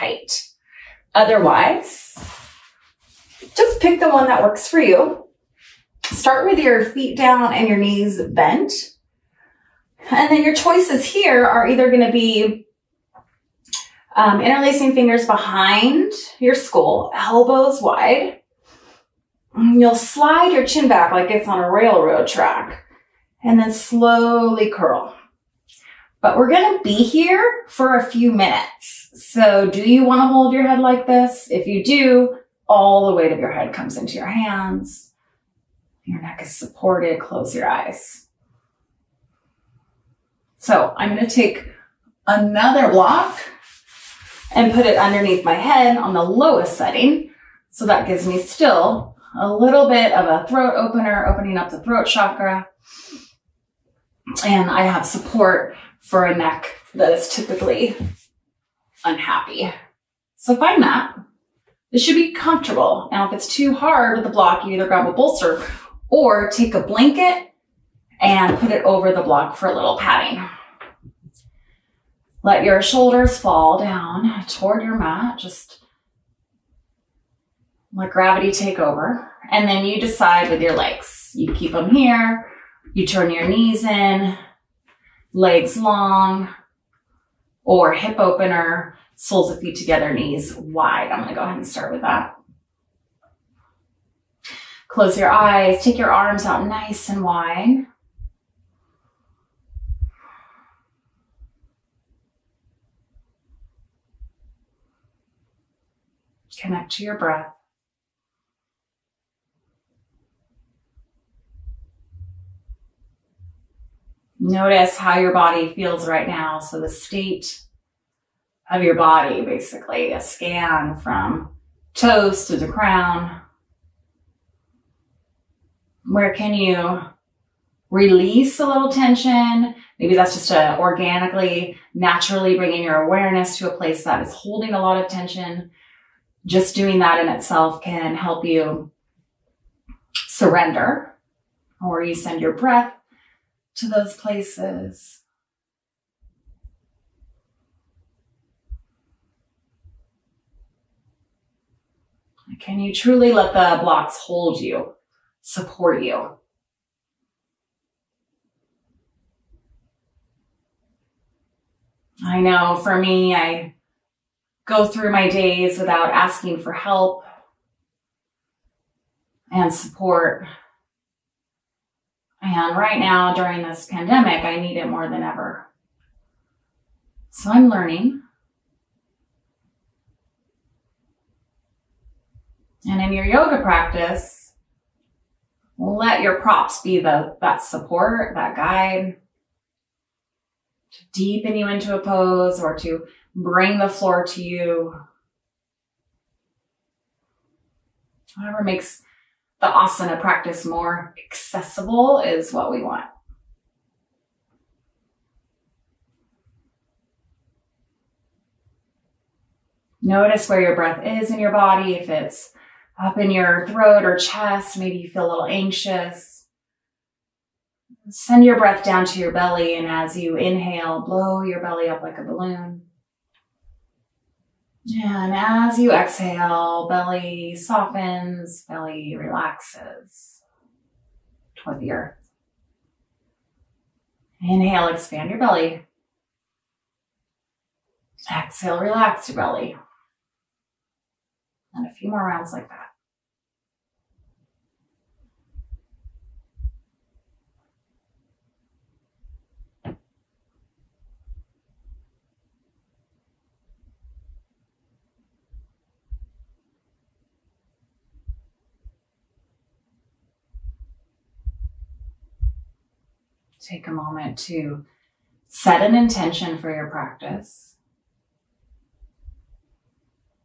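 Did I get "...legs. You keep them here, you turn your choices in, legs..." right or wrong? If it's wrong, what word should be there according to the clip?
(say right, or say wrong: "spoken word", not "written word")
wrong: "knees", not "choices".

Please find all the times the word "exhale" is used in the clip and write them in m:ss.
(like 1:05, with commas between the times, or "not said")
3:45, 3:58.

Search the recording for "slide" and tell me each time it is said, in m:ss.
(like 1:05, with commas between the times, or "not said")
0:19.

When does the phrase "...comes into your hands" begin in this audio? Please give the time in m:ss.
0:33.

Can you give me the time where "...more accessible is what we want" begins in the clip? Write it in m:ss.
3:20.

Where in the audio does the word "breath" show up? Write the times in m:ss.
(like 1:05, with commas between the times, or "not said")
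1:47, 2:22, 3:30, 3:38.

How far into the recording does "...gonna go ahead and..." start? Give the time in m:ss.
1:31.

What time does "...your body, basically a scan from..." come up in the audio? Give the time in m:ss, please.
1:58.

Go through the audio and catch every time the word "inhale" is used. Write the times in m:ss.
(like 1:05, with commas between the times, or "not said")
3:40, 3:54.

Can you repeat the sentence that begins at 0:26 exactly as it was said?
But we're gonna be here for a few minutes.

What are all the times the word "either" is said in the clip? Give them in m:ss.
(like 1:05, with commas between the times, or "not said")
0:11, 1:04.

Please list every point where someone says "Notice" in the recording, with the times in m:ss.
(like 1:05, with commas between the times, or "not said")
1:54, 3:30.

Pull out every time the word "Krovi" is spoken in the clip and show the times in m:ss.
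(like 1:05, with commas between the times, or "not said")
not said.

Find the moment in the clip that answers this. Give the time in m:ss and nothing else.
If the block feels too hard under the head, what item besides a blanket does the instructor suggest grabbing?
1:05.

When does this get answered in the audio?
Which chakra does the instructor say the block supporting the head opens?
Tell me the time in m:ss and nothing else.
0:51.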